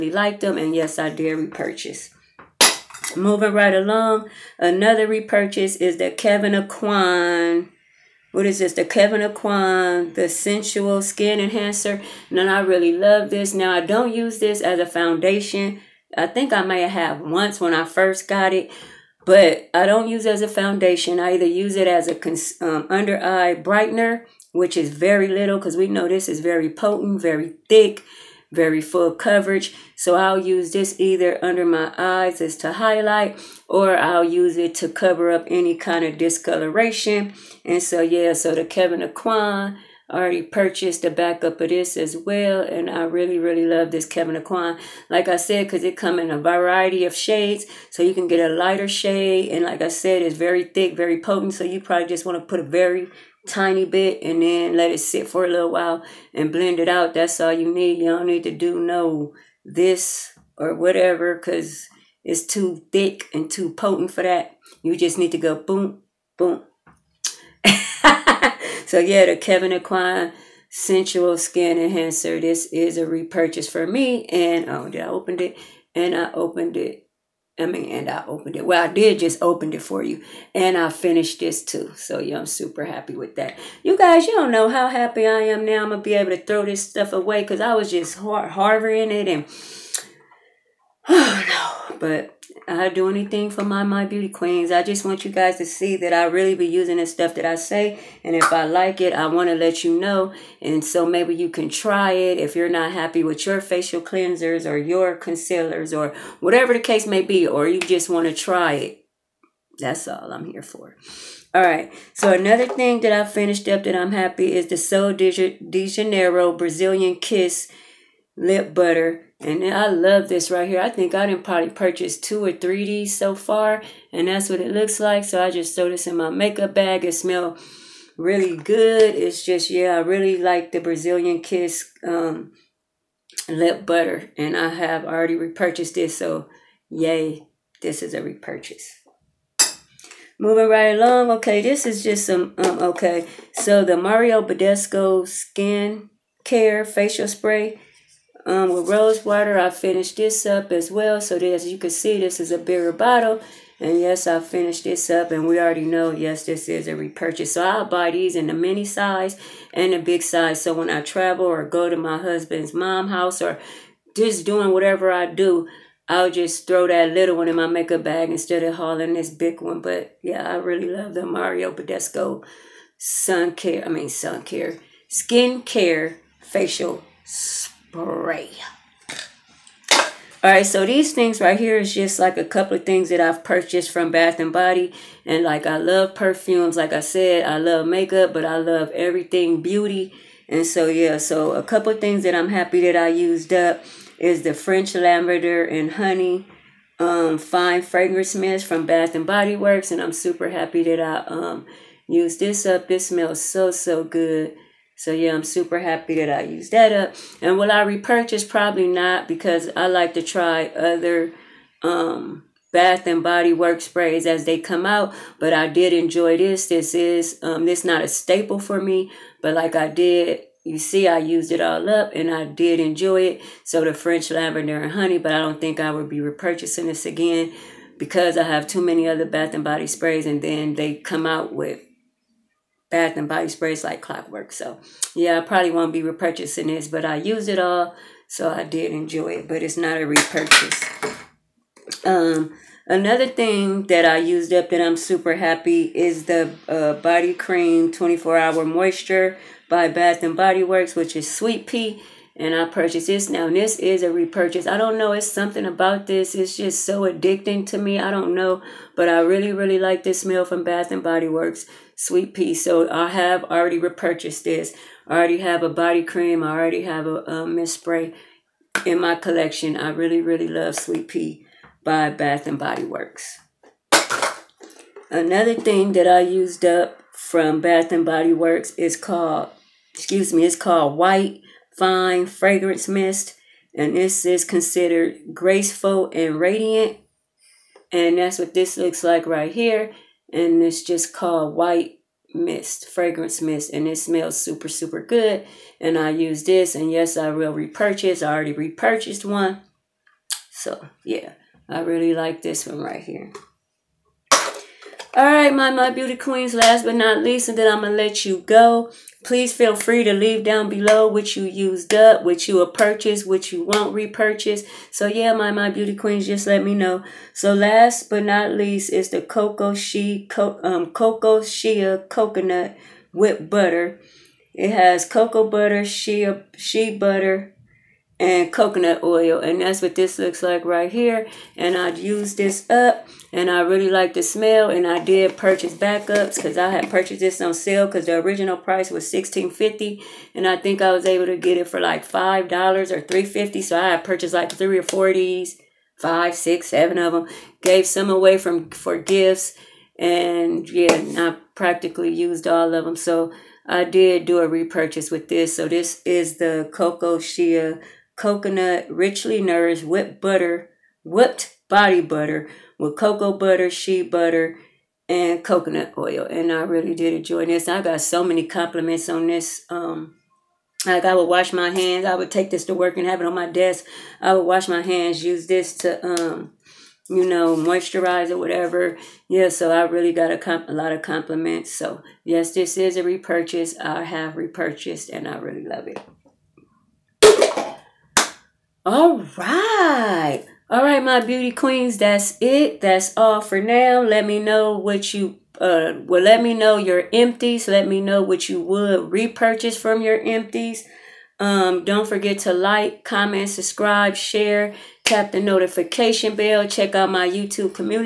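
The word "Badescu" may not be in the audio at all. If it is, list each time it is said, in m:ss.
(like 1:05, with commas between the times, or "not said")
2:24, 2:51.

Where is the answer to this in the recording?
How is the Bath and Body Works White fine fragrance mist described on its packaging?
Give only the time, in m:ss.
4:45.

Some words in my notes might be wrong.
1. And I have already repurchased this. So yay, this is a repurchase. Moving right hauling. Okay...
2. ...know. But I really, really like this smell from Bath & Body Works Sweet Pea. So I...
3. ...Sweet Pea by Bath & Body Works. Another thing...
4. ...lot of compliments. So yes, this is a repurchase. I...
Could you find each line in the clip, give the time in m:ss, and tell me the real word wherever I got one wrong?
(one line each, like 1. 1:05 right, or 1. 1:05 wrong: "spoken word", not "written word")
1. 2:14 wrong: "along", not "hauling"
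2. 4:18 right
3. 4:30 right
4. 6:20 right.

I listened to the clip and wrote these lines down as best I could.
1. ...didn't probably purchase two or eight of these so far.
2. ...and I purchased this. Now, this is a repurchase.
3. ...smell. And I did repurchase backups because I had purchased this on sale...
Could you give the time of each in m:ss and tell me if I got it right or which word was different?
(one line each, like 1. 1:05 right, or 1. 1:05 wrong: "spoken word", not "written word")
1. 2:01 wrong: "three", not "eight"
2. 4:12 right
3. 5:34 wrong: "purchase", not "repurchase".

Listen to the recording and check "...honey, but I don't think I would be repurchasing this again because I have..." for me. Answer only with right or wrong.
right.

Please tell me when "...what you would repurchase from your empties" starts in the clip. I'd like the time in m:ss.
6:38.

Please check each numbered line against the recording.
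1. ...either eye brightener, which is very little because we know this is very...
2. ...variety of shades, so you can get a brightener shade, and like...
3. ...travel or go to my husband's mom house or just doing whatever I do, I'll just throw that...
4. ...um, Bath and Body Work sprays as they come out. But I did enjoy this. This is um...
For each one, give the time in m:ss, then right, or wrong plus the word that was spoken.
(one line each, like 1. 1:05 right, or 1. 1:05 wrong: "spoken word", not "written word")
1. 0:22 wrong: "under", not "either"
2. 0:46 wrong: "lighter", not "brightener"
3. 2:41 right
4. 3:31 right.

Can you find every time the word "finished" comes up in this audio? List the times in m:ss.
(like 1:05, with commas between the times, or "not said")
1:20, 1:53, 2:29, 2:34.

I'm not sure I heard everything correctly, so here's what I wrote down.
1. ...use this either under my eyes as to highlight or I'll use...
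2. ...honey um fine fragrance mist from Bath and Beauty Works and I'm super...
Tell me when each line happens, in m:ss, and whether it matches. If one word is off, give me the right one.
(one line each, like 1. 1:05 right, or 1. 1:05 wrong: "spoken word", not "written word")
1. 0:30 right
2. 3:15 wrong: "Body", not "Beauty".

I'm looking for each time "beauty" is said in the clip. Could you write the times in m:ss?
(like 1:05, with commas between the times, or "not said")
1:34, 3:09, 5:05, 5:15, 6:31.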